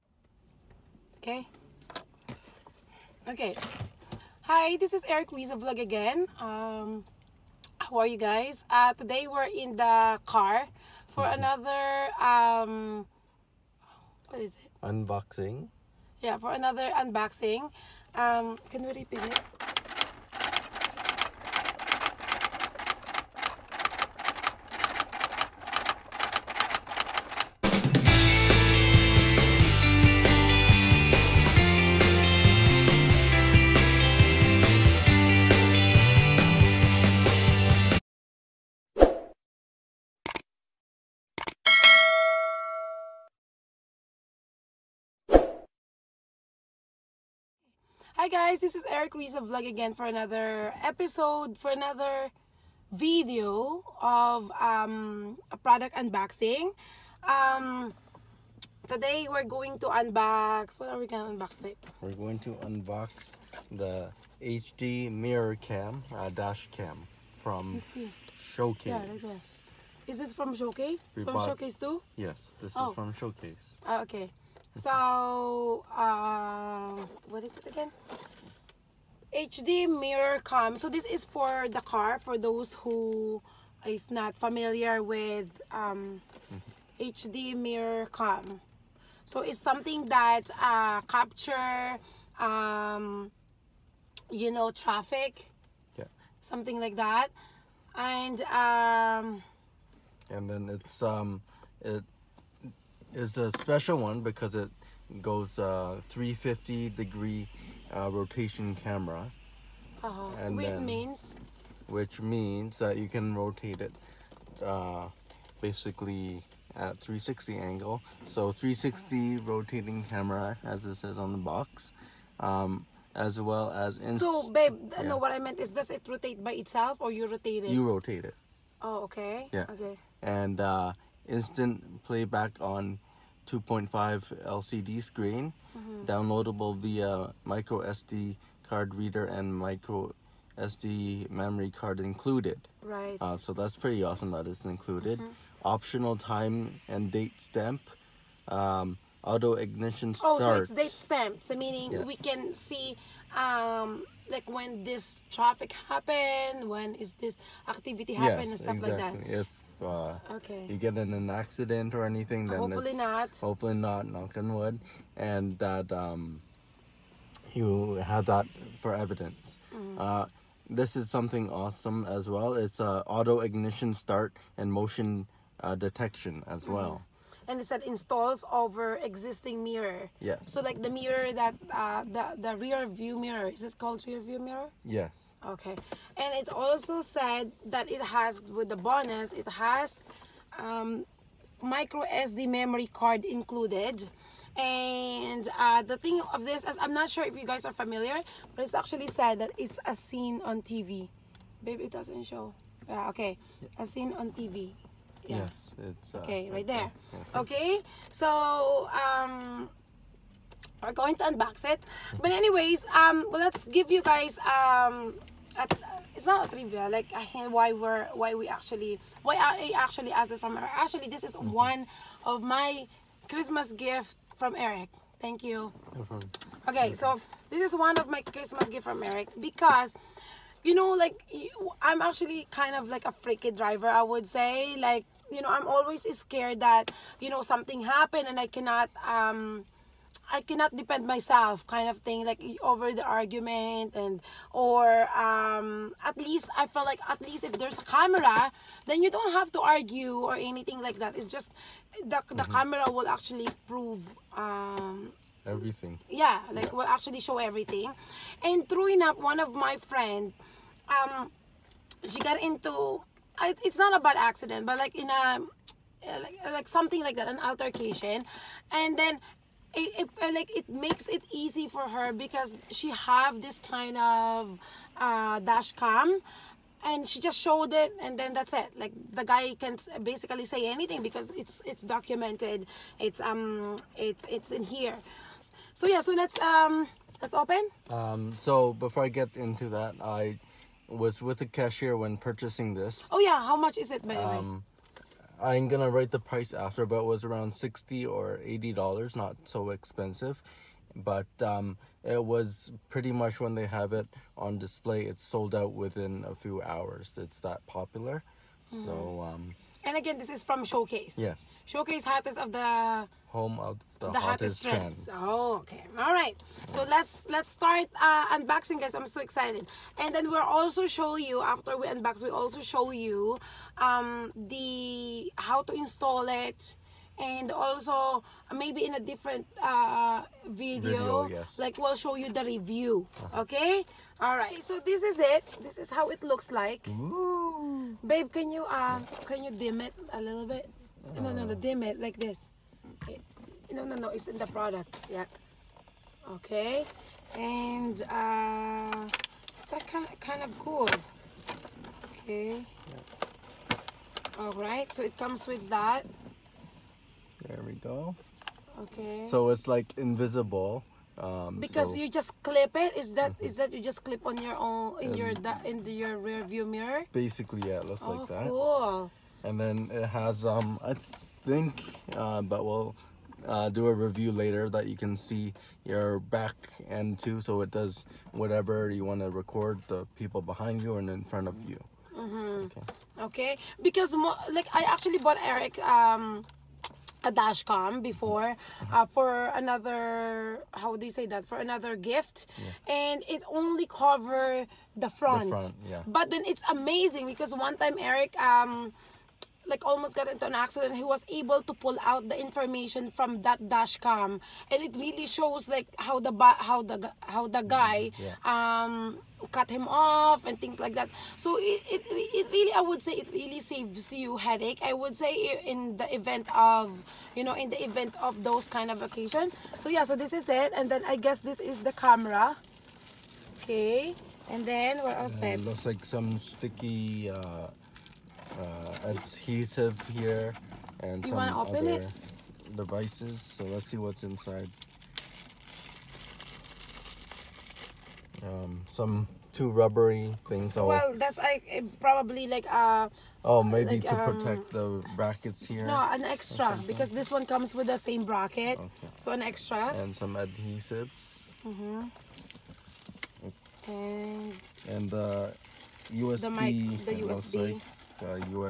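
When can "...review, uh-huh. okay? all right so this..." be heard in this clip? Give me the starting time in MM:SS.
05:32.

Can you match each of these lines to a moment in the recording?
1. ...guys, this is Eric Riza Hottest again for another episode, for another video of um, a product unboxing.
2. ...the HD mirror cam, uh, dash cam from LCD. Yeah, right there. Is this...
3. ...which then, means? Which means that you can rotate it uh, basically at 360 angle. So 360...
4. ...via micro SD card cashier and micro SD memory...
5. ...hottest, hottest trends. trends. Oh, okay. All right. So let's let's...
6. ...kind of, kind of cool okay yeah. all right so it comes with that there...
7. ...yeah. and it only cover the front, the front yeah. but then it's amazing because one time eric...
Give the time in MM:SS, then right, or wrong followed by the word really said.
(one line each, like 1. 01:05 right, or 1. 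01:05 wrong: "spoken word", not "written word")
1. 00:48 wrong: "Vlog", not "Hottest"
2. 01:03 wrong: "Showcase", not "LCD"
3. 01:50 right
4. 02:16 wrong: "reader", not "cashier"
5. 05:14 right
6. 05:49 right
7. 06:32 right.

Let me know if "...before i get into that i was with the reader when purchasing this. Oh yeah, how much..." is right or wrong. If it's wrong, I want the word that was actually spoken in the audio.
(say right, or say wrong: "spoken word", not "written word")
wrong: "cashier", not "reader".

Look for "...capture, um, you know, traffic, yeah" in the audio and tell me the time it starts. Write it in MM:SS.
01:31.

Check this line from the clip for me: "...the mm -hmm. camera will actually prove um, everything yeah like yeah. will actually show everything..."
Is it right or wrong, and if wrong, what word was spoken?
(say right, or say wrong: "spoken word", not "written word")
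right.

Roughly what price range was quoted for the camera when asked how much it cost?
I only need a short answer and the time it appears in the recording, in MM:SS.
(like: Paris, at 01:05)
$60 to $80, at 04:57.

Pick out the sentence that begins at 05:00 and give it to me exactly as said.
But um, it was pretty much when they have it on display, it's sold out within a few hours.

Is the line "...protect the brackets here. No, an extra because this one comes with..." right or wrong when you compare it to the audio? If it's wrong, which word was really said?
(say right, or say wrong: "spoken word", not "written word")
right.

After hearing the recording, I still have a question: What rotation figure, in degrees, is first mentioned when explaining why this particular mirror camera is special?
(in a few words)
350.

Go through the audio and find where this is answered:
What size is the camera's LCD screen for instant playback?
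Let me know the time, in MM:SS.
02:13.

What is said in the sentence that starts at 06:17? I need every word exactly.
So it does whatever you want to record the people behind you and in front of you.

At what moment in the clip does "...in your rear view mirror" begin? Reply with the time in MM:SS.
06:05.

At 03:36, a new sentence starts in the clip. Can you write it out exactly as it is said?
Like why we're why we actually why I actually asked this from her.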